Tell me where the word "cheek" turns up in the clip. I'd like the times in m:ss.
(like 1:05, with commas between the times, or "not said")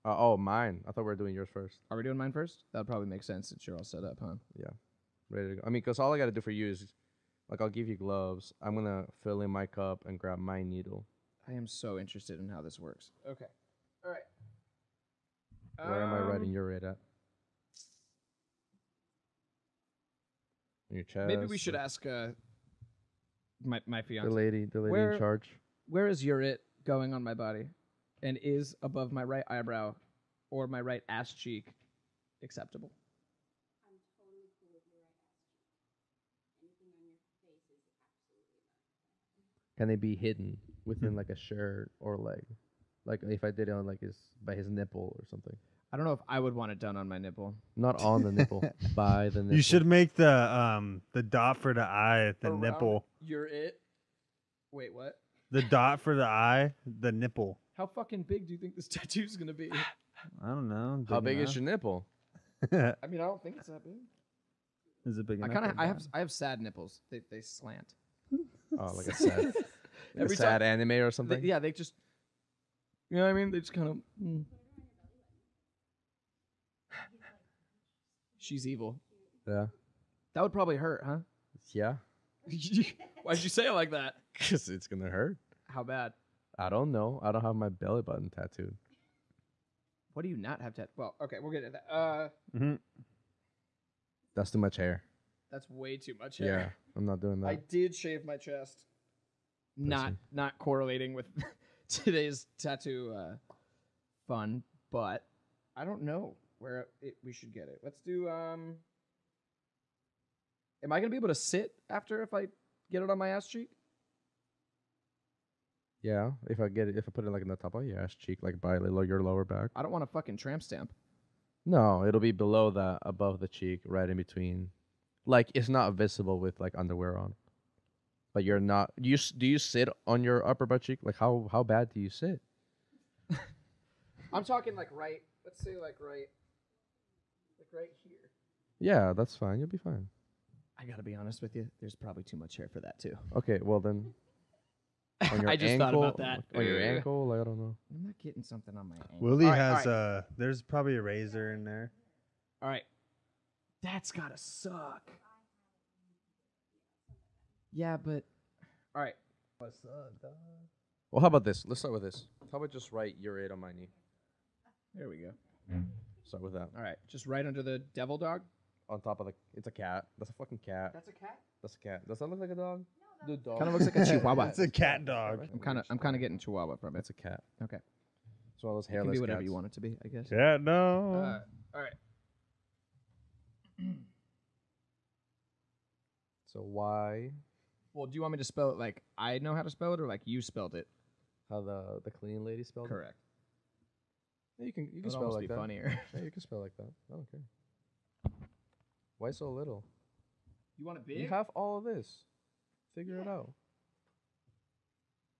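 0:31, 0:36, 1:53, 1:58, 2:03, 2:10.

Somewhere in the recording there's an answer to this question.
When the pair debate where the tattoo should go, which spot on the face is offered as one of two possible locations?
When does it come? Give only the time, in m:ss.
0:28.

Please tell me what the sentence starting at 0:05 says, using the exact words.
I mean, because all I gotta do for you is, like, I'll give you gloves.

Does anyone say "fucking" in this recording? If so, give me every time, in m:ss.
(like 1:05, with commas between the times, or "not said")
0:57, 2:00, 2:50.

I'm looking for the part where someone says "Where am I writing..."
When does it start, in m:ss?
0:15.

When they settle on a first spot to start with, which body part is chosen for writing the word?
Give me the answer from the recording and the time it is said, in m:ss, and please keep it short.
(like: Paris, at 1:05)
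Knee, at 2:43.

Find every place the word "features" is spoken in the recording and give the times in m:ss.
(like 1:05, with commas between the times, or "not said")
not said.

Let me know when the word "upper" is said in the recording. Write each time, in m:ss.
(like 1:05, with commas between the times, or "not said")
2:10.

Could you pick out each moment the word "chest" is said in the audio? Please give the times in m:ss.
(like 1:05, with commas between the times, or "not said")
0:21, 1:38.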